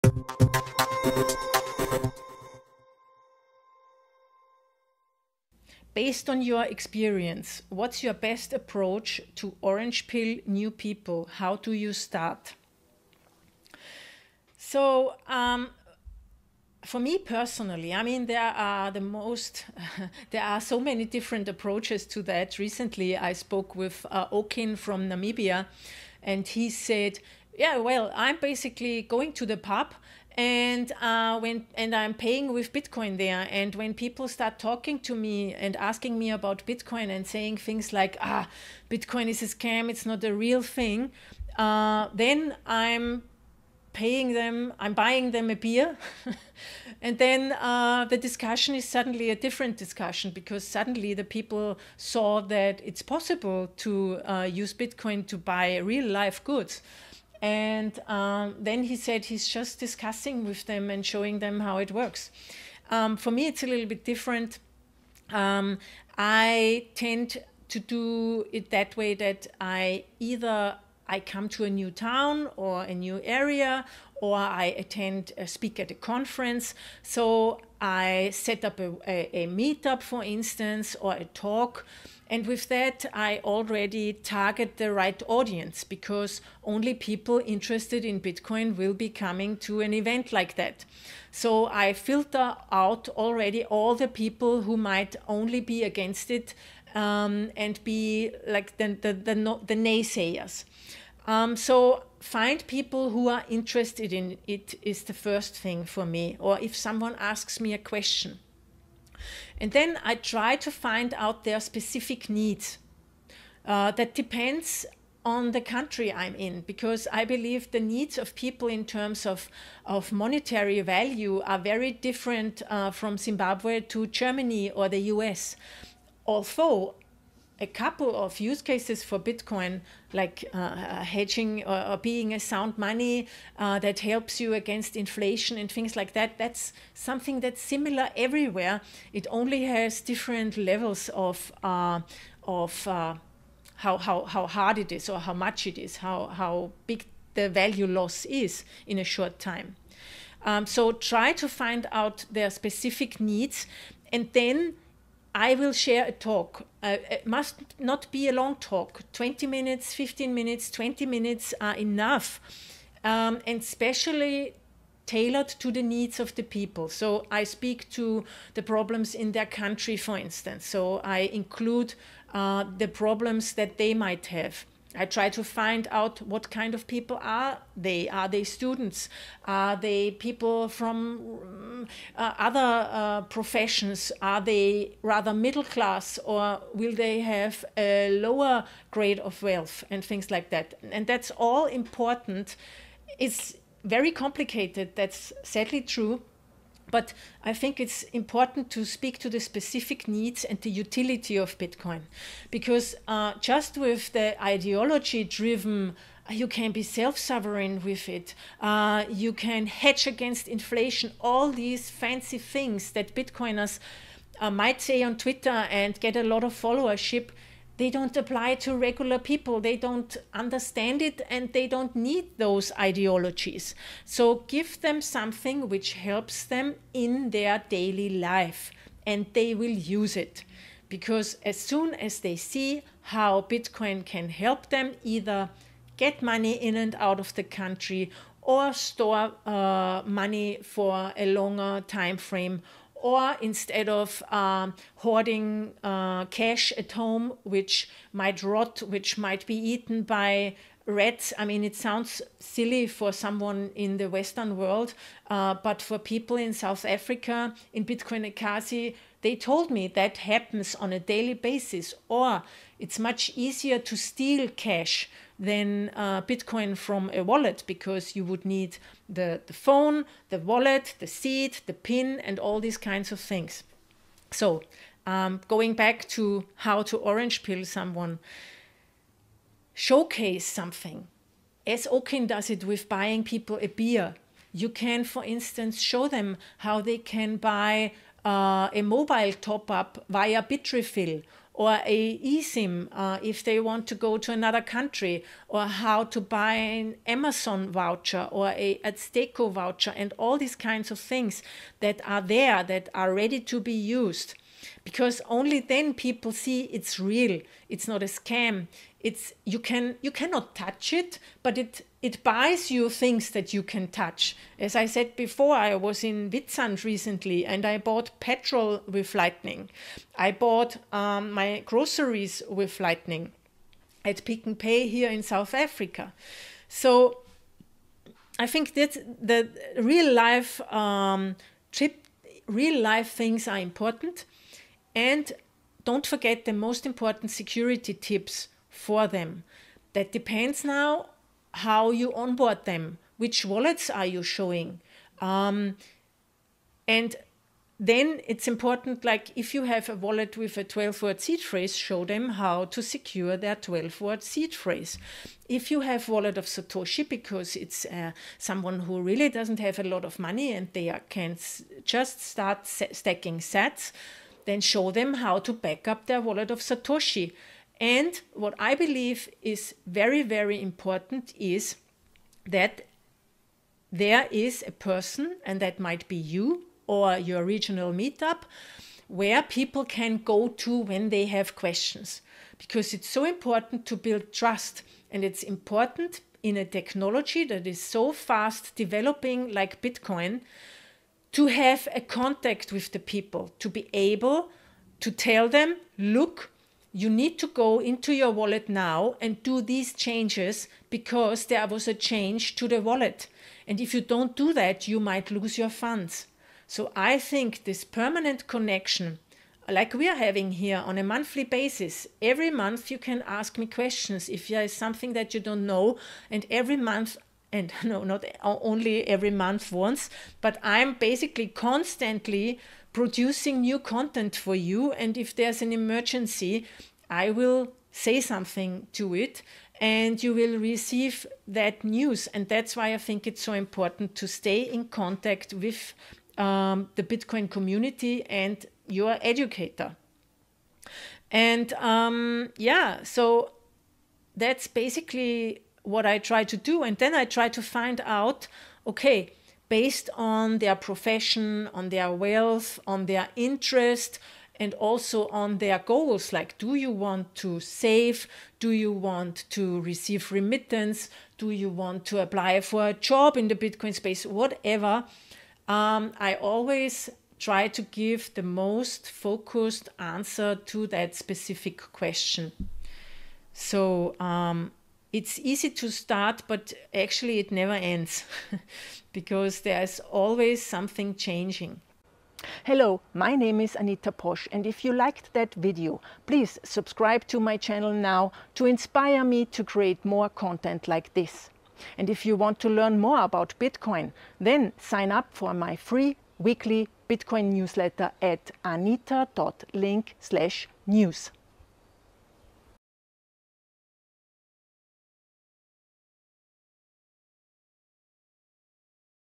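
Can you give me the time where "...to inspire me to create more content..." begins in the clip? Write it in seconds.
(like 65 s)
488 s.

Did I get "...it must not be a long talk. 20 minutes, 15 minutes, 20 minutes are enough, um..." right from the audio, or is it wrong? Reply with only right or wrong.
right.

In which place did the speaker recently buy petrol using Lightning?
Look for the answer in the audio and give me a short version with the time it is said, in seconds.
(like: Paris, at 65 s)
Witsand, at 316 s.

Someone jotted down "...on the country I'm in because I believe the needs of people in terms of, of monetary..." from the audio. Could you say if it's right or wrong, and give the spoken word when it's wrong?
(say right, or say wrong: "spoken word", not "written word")
right.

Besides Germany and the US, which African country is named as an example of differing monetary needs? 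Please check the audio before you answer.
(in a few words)
Zimbabwe.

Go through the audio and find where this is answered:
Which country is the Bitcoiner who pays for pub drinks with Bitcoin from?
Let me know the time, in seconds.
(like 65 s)
25 s.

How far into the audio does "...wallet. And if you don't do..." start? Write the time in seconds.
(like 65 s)
402 s.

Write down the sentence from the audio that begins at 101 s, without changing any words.
Um, so find people who are interested in it is the first thing for me.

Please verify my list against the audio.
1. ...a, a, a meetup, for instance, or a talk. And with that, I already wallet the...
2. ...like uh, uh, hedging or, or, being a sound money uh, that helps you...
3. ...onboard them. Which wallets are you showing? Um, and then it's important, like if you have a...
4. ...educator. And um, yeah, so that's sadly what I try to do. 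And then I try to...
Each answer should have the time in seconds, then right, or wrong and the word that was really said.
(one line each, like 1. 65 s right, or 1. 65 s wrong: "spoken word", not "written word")
1. 78 s wrong: "target", not "wallet"
2. 130 s right
3. 342 s right
4. 439 s wrong: "basically", not "sadly".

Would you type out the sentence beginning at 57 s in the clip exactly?
And um, then he said he's just discussing with them and showing them how it works.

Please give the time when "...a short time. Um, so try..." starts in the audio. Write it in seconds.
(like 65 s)
148 s.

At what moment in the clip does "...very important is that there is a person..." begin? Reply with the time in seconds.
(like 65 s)
370 s.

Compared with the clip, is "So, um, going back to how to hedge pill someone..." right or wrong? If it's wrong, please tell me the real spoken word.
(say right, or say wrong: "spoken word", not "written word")
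wrong: "orange", not "hedge".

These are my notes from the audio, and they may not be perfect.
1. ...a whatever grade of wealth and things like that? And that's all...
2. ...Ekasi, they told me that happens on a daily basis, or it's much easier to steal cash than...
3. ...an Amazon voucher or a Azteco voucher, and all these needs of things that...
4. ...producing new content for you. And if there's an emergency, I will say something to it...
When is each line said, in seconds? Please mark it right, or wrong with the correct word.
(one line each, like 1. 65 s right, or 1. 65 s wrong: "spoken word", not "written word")
1. 187 s wrong: "lower", not "whatever"
2. 258 s right
3. 296 s wrong: "kinds", not "needs"
4. 422 s right.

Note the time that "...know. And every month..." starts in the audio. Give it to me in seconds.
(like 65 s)
415 s.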